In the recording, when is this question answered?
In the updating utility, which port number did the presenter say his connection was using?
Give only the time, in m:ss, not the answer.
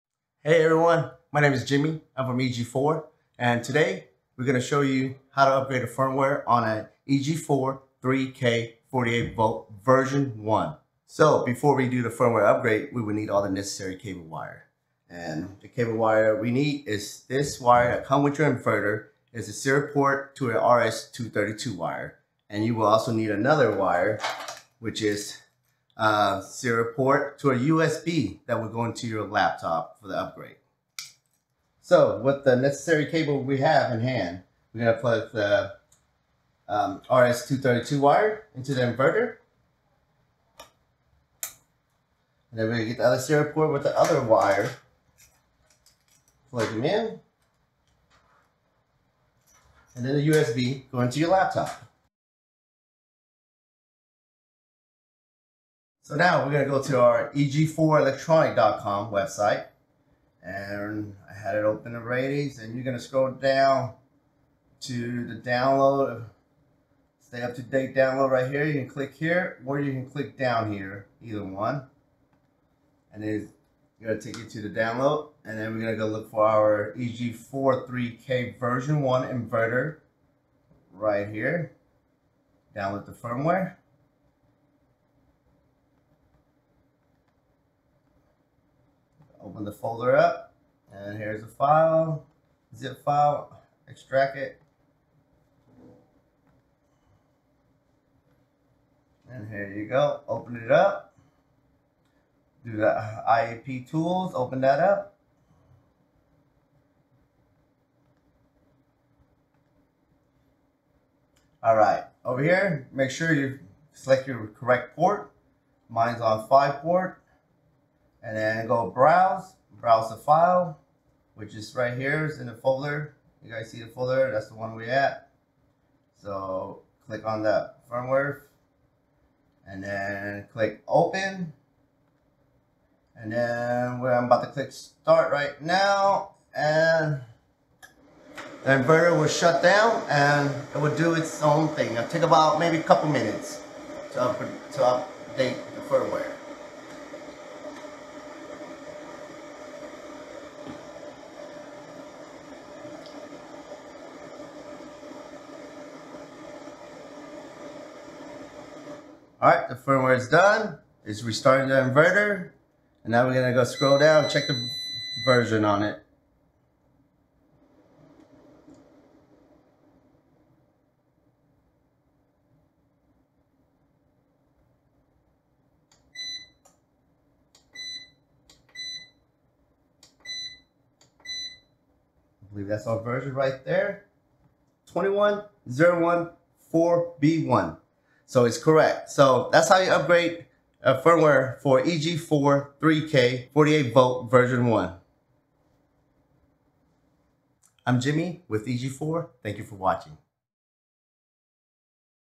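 1:56.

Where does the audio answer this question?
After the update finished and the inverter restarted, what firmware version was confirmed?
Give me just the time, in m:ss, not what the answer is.
3:04.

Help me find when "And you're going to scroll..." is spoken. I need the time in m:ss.
1:02.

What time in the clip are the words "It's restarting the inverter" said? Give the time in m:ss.
2:41.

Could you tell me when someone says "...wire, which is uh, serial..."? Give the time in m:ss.
0:23.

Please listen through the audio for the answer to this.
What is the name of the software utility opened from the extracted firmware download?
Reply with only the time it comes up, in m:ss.
1:43.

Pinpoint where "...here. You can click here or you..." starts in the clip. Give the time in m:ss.
1:08.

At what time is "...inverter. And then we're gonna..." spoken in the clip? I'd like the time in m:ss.
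0:38.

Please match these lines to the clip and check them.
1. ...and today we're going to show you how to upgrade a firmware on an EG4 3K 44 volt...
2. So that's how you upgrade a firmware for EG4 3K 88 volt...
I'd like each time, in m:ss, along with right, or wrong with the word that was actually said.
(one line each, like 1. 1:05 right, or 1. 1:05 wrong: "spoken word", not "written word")
1. 0:03 wrong: "48", not "44"
2. 3:09 wrong: "48", not "88".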